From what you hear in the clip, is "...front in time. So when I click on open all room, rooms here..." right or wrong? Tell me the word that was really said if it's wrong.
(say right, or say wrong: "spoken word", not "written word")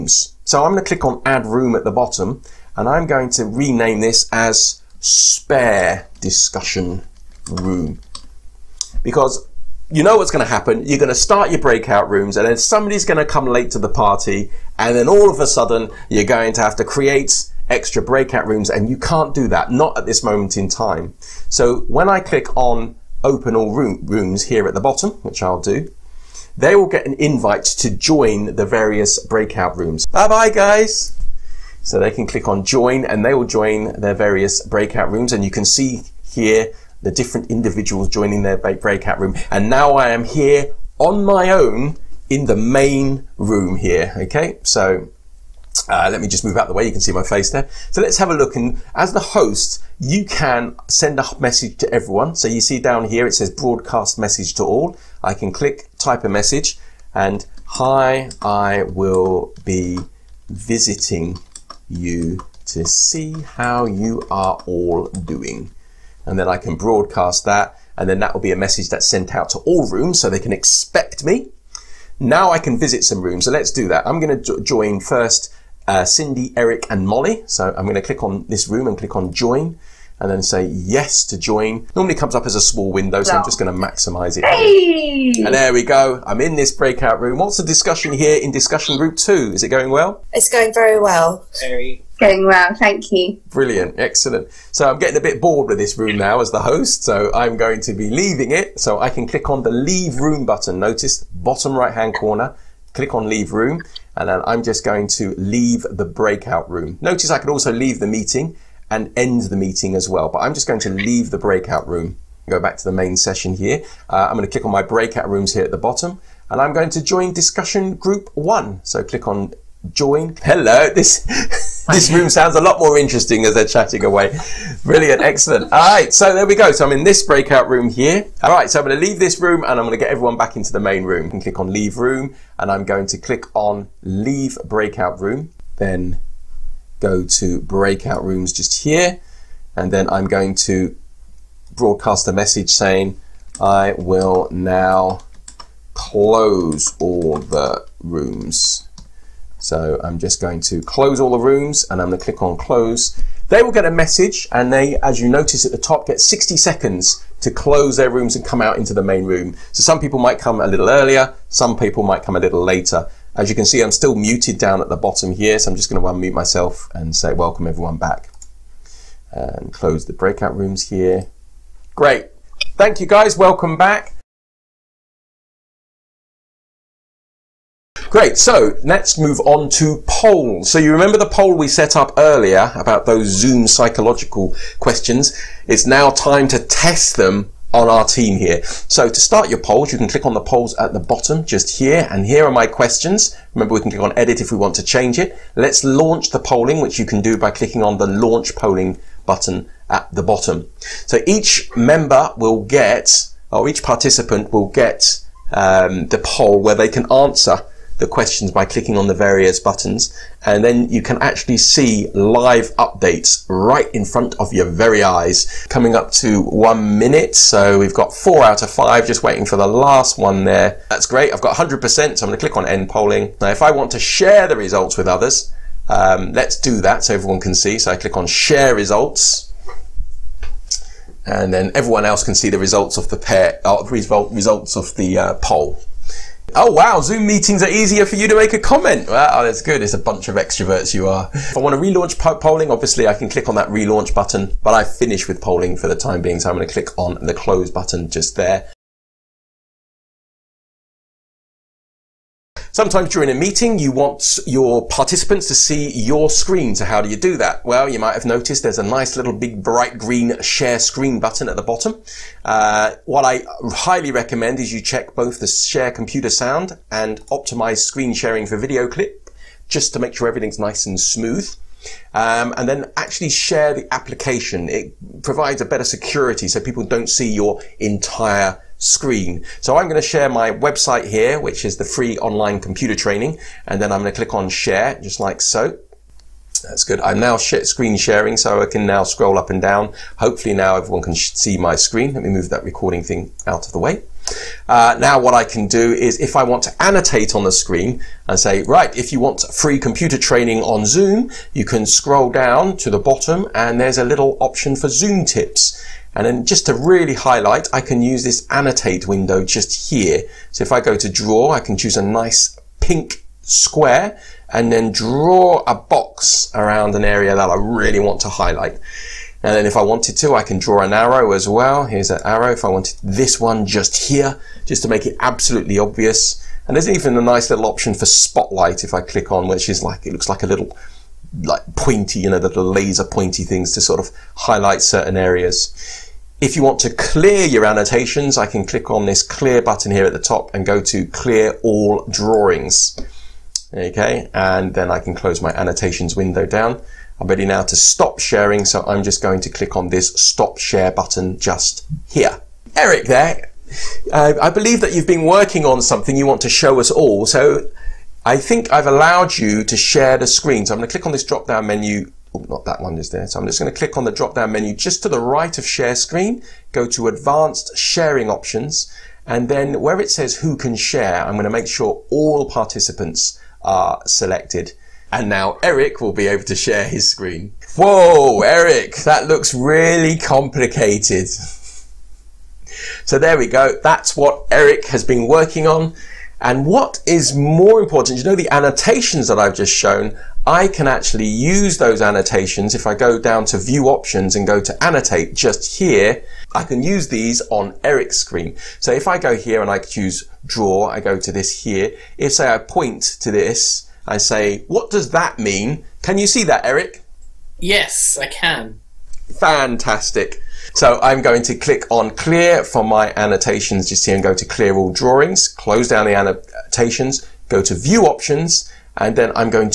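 wrong: "moment", not "front".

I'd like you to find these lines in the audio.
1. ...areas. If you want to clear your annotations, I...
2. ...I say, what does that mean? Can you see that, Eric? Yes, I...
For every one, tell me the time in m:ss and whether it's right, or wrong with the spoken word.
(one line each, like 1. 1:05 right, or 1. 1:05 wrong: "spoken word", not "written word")
1. 5:35 right
2. 6:44 right.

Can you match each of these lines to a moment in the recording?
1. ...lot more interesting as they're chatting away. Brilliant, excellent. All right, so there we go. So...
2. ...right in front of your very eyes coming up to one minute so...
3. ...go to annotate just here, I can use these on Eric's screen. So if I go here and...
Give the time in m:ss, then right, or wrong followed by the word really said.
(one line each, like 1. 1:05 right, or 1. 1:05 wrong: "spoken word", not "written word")
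1. 2:02 right
2. 3:33 right
3. 6:34 right.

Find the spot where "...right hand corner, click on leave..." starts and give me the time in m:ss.
1:41.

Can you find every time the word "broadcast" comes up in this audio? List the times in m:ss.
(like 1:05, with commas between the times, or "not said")
0:53, 1:06, 2:21.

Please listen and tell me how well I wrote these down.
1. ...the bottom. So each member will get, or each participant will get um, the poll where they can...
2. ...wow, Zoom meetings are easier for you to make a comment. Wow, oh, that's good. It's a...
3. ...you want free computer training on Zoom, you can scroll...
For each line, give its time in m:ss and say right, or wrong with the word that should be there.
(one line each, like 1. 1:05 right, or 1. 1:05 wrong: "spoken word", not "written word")
1. 3:20 right
2. 3:56 right
3. 4:59 right.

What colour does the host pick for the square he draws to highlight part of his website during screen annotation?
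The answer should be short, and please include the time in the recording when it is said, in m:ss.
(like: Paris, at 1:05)
pink, at 5:12.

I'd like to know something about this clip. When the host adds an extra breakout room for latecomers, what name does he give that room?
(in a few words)
spare discussion room.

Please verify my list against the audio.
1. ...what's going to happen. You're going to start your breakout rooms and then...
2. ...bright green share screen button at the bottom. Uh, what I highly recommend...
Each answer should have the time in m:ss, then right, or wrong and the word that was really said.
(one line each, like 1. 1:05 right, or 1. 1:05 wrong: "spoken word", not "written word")
1. 0:10 right
2. 4:19 right.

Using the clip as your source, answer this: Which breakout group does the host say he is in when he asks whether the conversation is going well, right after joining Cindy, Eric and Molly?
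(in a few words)
discussion group two.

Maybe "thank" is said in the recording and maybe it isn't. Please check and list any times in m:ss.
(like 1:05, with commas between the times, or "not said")
1:32, 2:52.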